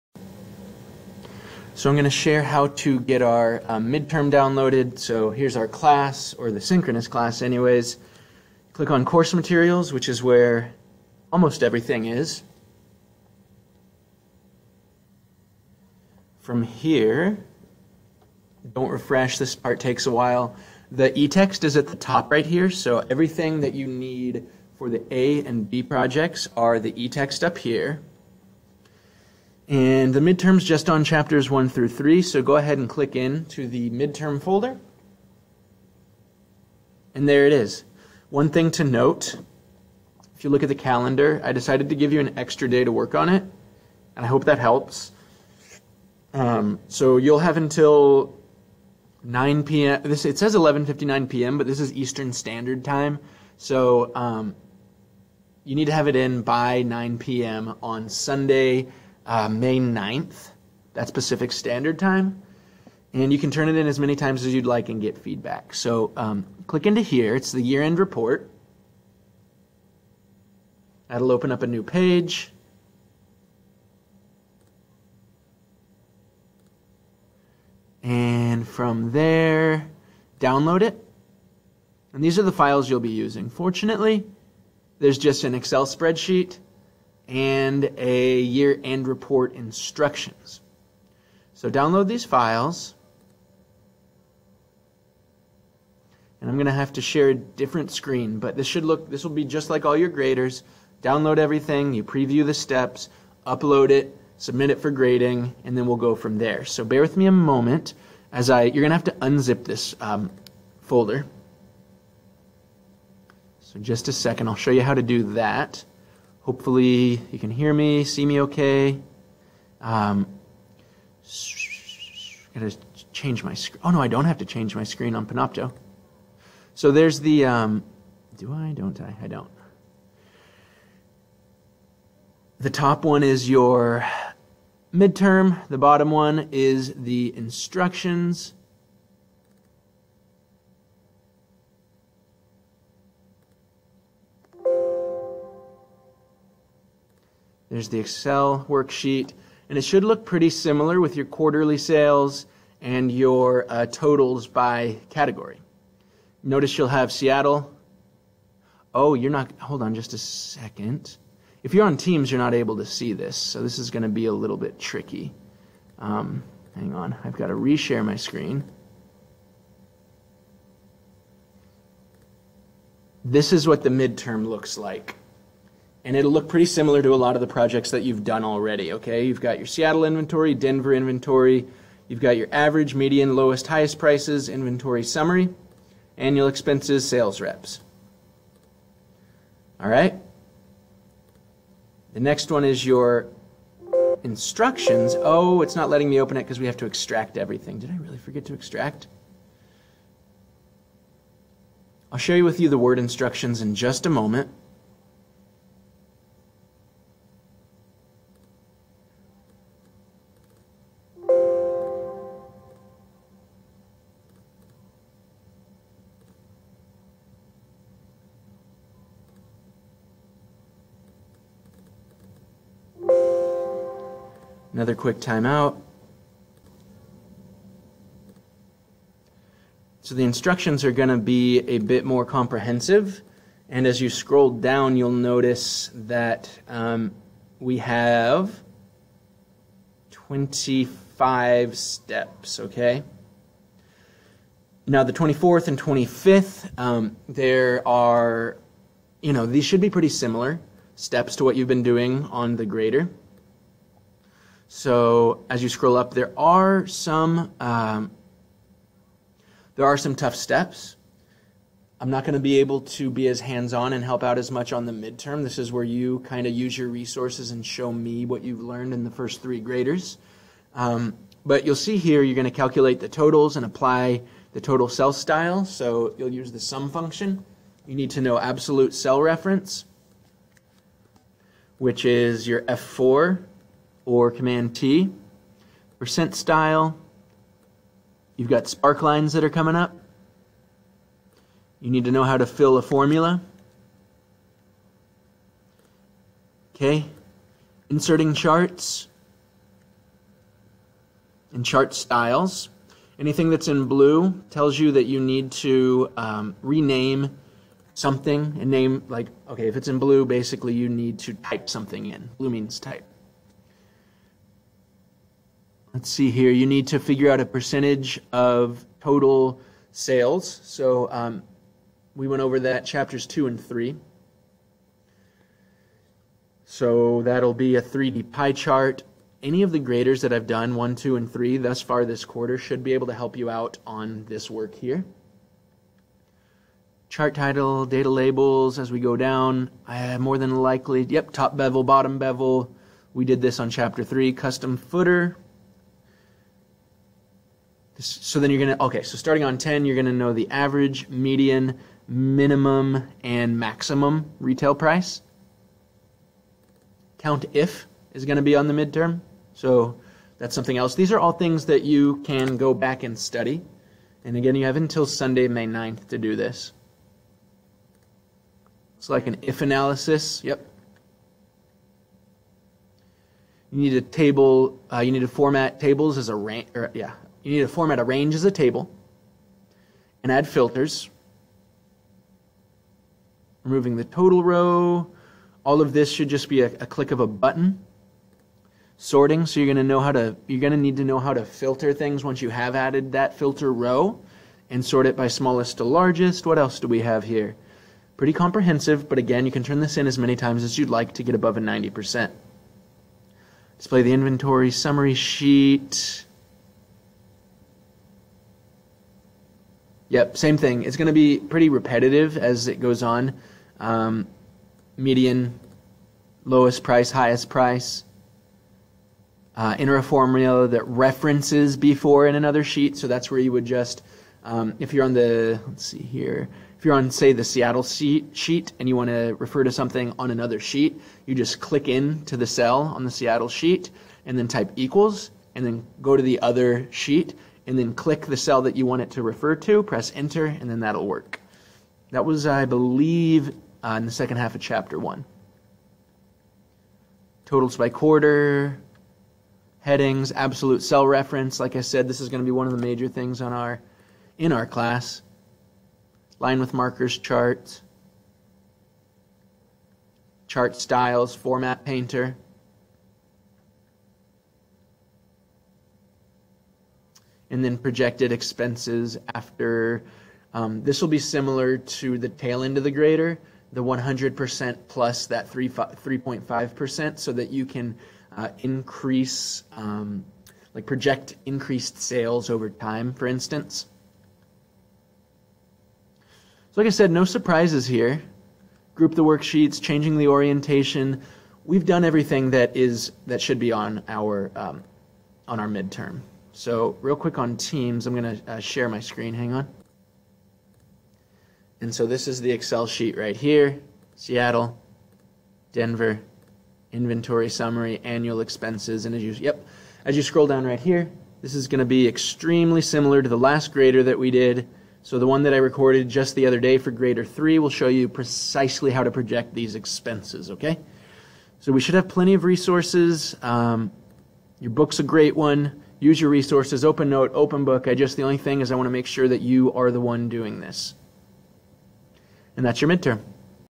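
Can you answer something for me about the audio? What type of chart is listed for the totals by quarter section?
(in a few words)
Line with markers.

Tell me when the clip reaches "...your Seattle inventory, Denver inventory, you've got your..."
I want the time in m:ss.
2:59.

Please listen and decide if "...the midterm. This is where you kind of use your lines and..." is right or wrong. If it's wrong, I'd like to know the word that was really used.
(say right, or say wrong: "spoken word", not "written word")
wrong: "resources", not "lines".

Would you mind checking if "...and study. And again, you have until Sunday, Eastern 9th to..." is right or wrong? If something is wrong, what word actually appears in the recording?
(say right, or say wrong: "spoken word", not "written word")
wrong: "May", not "Eastern".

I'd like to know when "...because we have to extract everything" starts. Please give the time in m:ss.
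3:16.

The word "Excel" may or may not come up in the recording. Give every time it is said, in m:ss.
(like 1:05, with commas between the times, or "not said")
1:25, 2:27, 8:22.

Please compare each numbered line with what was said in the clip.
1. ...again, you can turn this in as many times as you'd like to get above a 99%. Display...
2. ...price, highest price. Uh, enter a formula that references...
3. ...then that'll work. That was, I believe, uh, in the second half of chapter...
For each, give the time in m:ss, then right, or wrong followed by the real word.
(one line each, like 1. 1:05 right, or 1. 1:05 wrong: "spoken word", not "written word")
1. 6:39 wrong: "90", not "99"
2. 6:56 right
3. 7:20 right.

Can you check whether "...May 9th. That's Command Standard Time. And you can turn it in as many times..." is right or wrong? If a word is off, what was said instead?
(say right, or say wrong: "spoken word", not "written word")
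wrong: "Pacific", not "Command".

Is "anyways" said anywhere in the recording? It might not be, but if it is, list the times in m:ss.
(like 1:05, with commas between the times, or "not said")
0:07.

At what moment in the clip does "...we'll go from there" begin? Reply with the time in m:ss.
1:45.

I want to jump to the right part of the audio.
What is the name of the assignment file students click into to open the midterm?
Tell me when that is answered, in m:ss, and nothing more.
1:07.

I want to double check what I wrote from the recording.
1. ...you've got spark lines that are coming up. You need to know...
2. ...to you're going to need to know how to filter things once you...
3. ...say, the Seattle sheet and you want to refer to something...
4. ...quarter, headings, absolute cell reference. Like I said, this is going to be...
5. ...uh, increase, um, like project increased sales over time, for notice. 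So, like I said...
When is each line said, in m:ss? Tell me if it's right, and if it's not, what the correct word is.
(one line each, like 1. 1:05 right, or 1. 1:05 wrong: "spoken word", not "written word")
1. 4:48 right
2. 6:30 right
3. 7:07 right
4. 7:27 right
5. 7:58 wrong: "instance", not "notice".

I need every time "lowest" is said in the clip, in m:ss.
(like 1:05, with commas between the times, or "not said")
3:03, 6:56.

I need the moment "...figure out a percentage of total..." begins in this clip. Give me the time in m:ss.
5:16.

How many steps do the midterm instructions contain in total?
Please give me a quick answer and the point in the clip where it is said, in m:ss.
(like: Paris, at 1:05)
25, at 4:00.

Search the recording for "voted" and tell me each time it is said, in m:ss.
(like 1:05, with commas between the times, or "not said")
not said.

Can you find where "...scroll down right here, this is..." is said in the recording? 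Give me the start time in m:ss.
8:30.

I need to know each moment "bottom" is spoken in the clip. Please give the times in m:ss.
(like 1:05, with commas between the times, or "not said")
2:15, 5:41.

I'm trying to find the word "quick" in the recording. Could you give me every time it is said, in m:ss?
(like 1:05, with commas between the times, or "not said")
3:44, 8:17.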